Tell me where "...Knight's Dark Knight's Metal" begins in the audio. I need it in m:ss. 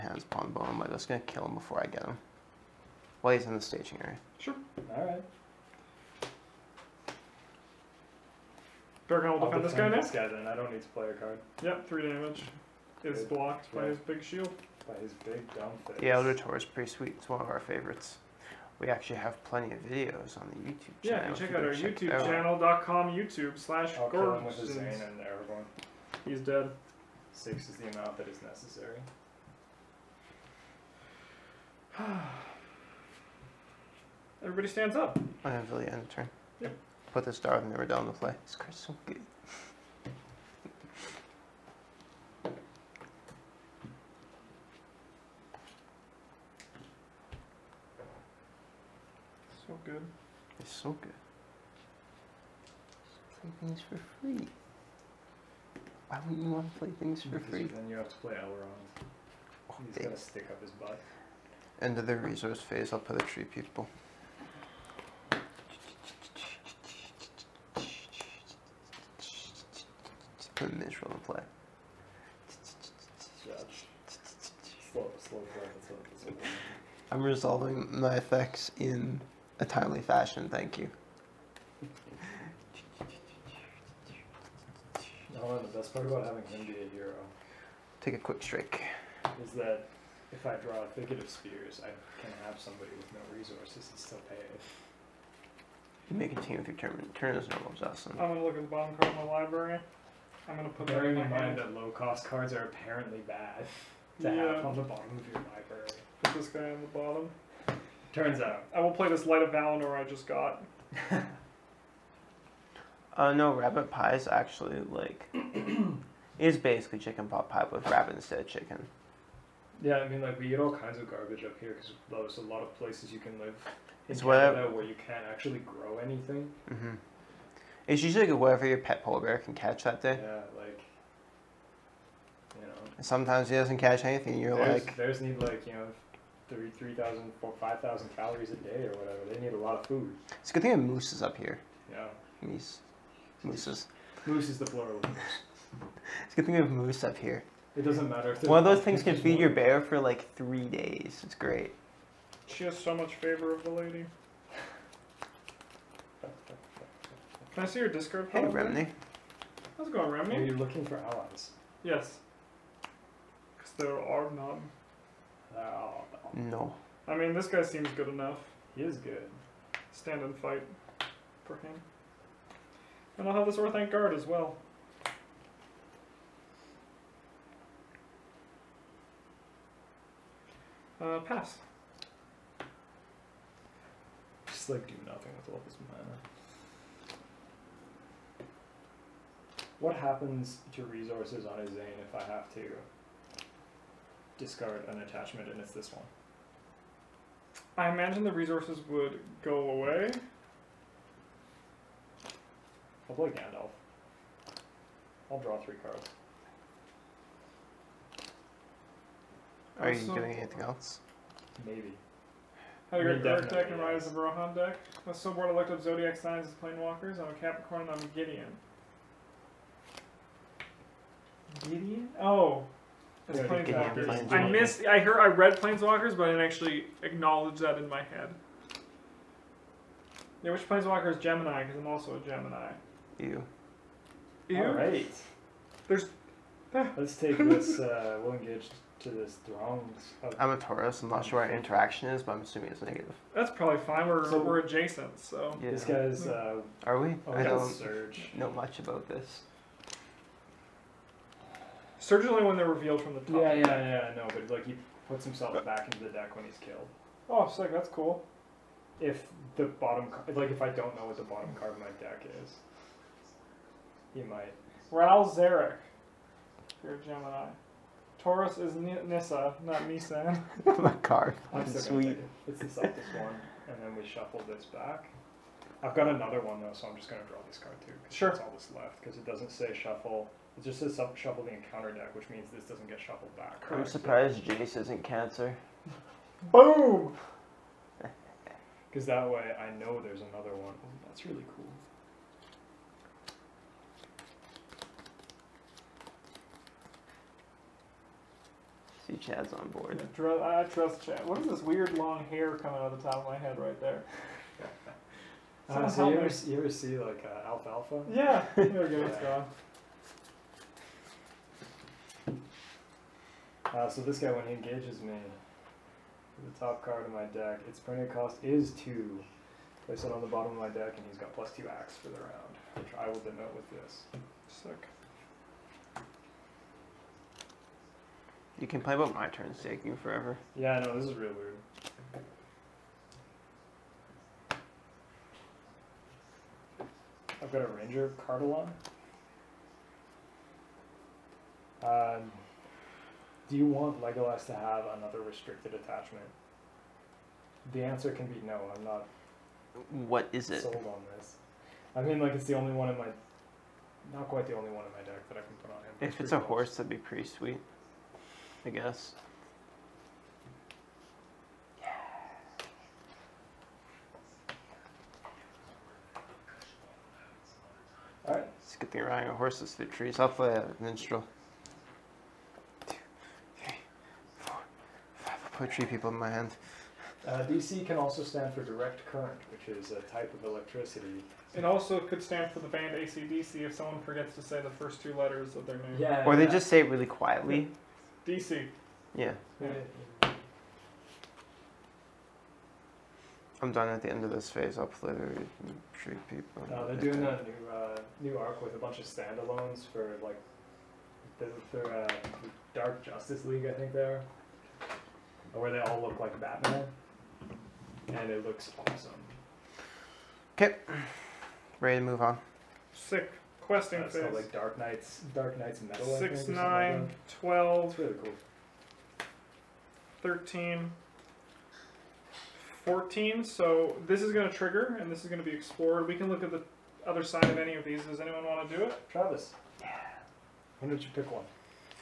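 6:54.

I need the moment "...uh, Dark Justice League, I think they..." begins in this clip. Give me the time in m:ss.
6:41.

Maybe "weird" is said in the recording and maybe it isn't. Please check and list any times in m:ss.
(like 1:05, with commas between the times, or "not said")
5:01, 5:31.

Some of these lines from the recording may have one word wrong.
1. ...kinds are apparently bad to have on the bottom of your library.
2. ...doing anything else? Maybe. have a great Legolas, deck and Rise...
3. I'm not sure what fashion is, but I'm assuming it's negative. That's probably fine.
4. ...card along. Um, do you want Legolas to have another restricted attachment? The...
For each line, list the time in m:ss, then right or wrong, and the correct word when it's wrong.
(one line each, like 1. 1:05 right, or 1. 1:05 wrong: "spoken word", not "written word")
1. 1:42 wrong: "cards", not "kinds"
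2. 3:30 wrong: "Definitely", not "Legolas"
3. 4:01 wrong: "interaction", not "fashion"
4. 5:38 right.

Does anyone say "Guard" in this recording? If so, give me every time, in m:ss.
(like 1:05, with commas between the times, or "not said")
2:53.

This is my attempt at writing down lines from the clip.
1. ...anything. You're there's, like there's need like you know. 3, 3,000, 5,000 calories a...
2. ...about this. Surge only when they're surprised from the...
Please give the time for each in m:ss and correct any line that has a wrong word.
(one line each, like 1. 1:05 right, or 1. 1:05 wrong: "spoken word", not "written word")
1. 2:14 right
2. 4:08 wrong: "revealed", not "surprised".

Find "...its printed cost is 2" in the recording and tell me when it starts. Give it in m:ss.
5:17.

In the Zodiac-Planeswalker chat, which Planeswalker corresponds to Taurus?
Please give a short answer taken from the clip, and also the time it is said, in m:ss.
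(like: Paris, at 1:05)
Nissa, at 4:29.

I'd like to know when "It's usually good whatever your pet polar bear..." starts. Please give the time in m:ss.
2:07.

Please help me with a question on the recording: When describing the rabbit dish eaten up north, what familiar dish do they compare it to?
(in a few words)
Chicken pot pie.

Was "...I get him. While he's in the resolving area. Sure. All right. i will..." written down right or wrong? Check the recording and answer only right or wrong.
wrong.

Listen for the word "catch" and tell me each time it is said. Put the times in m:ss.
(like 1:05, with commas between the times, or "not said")
2:09, 2:13.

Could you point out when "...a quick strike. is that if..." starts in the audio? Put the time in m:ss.
1:28.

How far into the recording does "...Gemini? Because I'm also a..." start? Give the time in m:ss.
3:51.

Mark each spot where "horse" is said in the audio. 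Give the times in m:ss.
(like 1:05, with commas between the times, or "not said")
5:56, 6:09.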